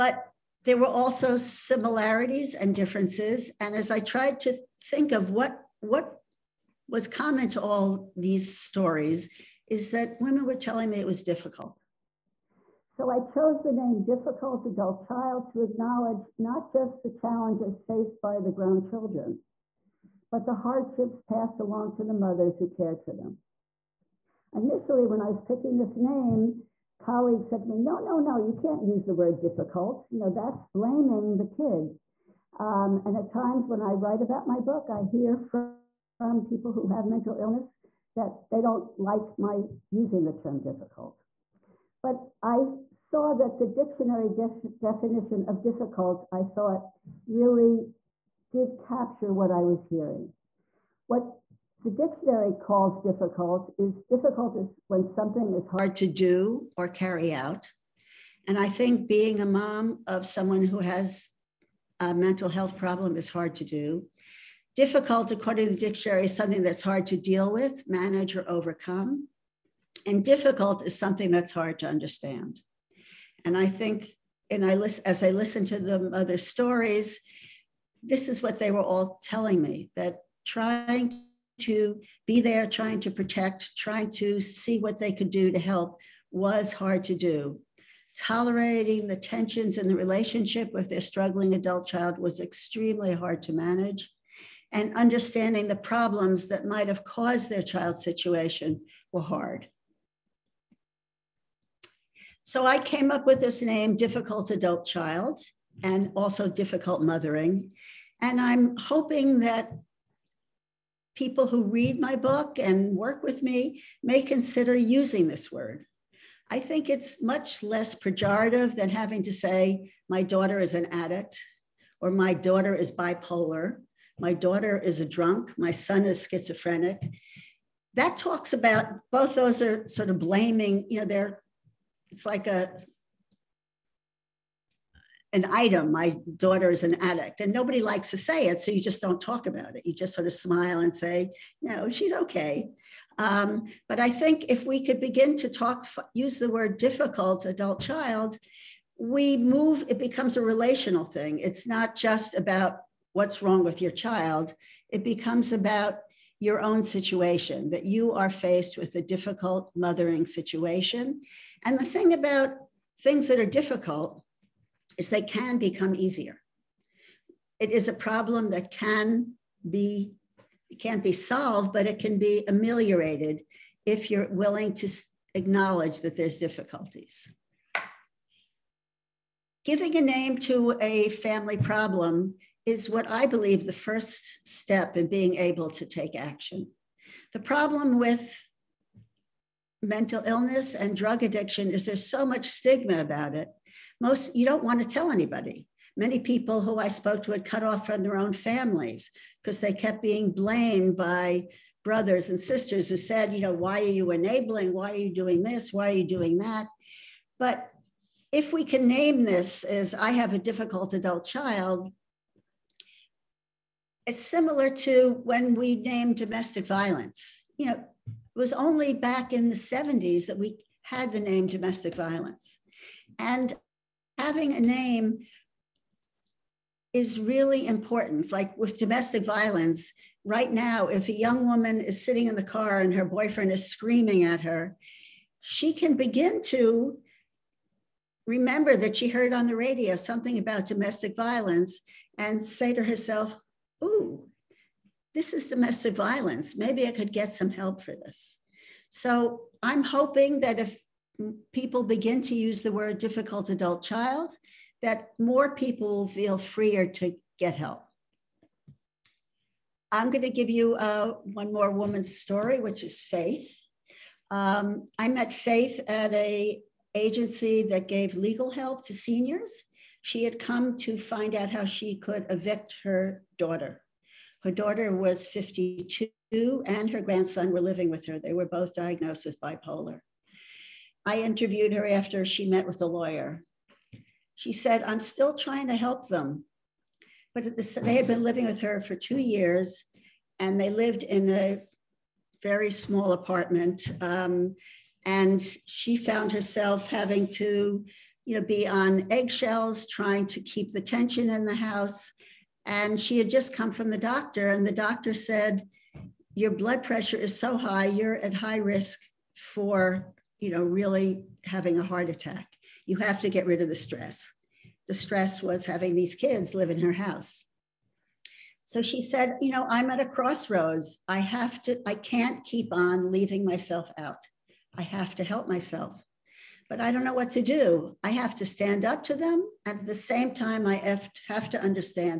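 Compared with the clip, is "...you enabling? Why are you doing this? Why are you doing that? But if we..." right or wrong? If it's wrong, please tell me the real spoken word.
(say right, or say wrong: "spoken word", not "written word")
right.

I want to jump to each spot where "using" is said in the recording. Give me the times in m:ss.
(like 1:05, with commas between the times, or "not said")
0:39, 1:54.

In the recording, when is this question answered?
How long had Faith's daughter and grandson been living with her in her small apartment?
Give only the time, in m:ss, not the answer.
4:48.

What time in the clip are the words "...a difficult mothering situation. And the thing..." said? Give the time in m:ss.
2:38.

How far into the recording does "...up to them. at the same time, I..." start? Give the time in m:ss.
5:28.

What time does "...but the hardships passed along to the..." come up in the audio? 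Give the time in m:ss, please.
0:20.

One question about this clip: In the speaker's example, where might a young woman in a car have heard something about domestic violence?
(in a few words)
On the radio.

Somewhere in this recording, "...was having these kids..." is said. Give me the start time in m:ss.
5:15.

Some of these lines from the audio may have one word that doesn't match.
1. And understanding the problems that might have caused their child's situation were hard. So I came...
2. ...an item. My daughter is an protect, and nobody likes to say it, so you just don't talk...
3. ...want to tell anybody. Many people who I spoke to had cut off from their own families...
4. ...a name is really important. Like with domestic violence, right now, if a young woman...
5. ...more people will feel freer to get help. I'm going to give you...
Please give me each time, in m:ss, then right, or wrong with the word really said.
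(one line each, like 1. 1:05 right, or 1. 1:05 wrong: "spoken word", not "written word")
1. 1:34 right
2. 2:15 wrong: "addict", not "protect"
3. 3:14 right
4. 3:44 right
5. 4:15 right.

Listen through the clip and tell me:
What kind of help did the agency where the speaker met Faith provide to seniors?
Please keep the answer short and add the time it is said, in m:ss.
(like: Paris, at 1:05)
Legal help, at 4:28.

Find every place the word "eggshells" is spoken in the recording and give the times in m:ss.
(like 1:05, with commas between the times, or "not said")
4:59.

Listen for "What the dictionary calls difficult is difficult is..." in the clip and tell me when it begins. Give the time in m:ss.
0:51.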